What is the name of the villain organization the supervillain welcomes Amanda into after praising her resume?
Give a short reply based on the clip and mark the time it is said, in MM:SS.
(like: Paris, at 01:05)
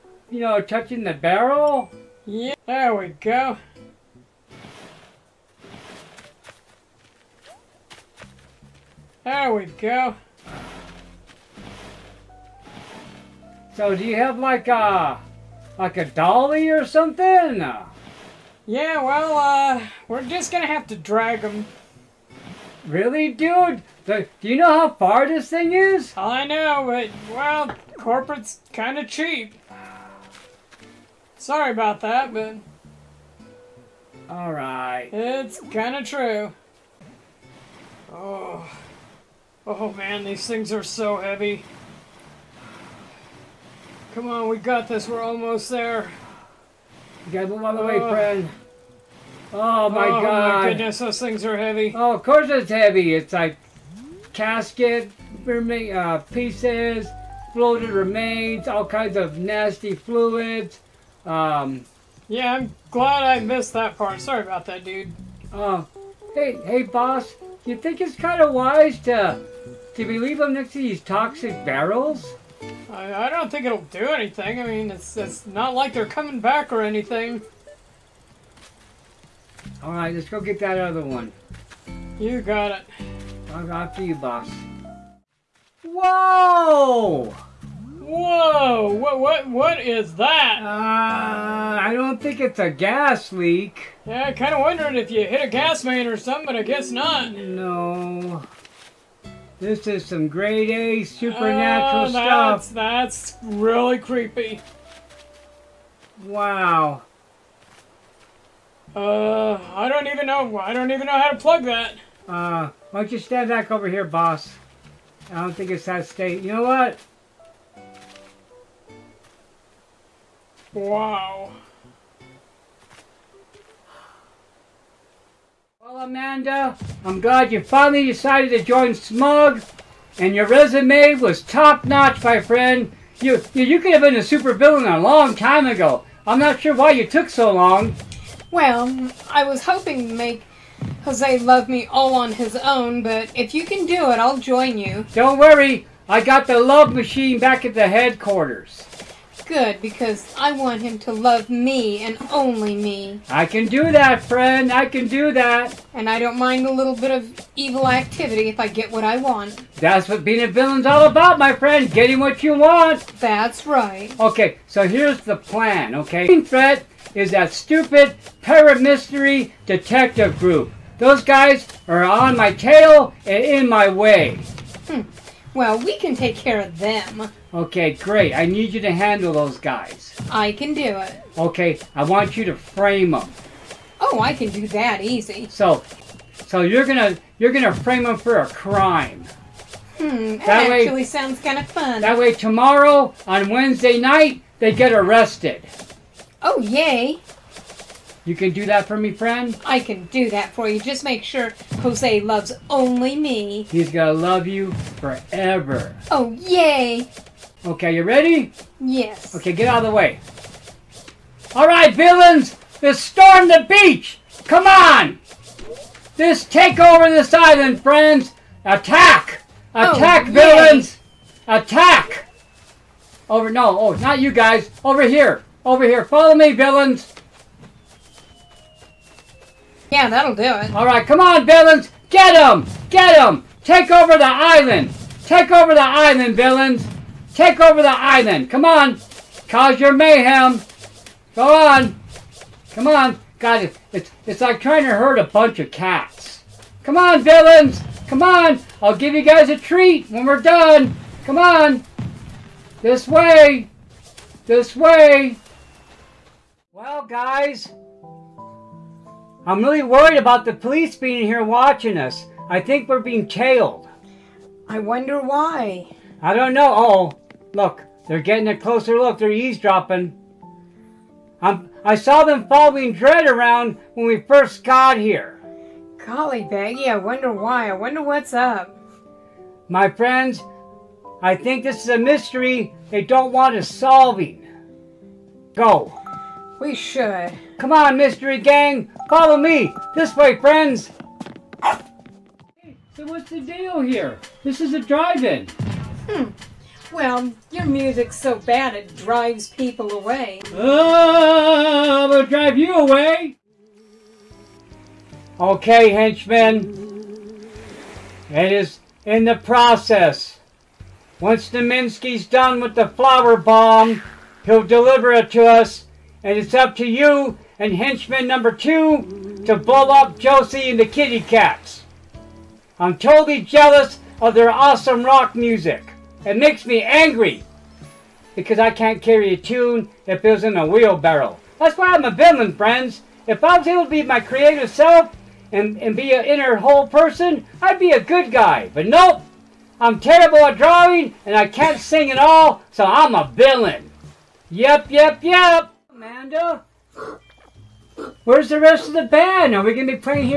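Smug, at 02:08.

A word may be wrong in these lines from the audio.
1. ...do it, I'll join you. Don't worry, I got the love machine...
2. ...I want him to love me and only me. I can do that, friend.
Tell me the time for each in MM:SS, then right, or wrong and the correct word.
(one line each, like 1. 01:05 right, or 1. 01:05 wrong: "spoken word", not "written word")
1. 02:23 right
2. 02:30 right.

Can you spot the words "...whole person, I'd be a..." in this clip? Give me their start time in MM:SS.
05:36.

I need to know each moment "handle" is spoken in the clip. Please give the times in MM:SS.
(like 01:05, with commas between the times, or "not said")
02:58.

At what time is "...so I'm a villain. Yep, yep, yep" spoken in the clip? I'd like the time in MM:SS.
05:42.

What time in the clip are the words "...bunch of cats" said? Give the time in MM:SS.
04:05.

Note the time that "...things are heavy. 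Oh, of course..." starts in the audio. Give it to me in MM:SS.
00:51.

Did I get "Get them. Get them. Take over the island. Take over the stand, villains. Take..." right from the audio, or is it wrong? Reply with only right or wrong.
wrong.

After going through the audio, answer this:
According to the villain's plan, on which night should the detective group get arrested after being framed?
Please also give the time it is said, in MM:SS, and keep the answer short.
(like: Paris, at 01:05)
Wednesday night, at 03:13.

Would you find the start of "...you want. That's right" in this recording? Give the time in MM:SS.
02:42.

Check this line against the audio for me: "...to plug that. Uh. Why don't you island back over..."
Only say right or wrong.
wrong.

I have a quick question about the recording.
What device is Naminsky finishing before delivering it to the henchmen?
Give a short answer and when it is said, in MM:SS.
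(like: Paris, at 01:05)
Flower bomb, at 05:12.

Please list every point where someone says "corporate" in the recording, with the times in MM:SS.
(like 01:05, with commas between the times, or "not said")
00:27.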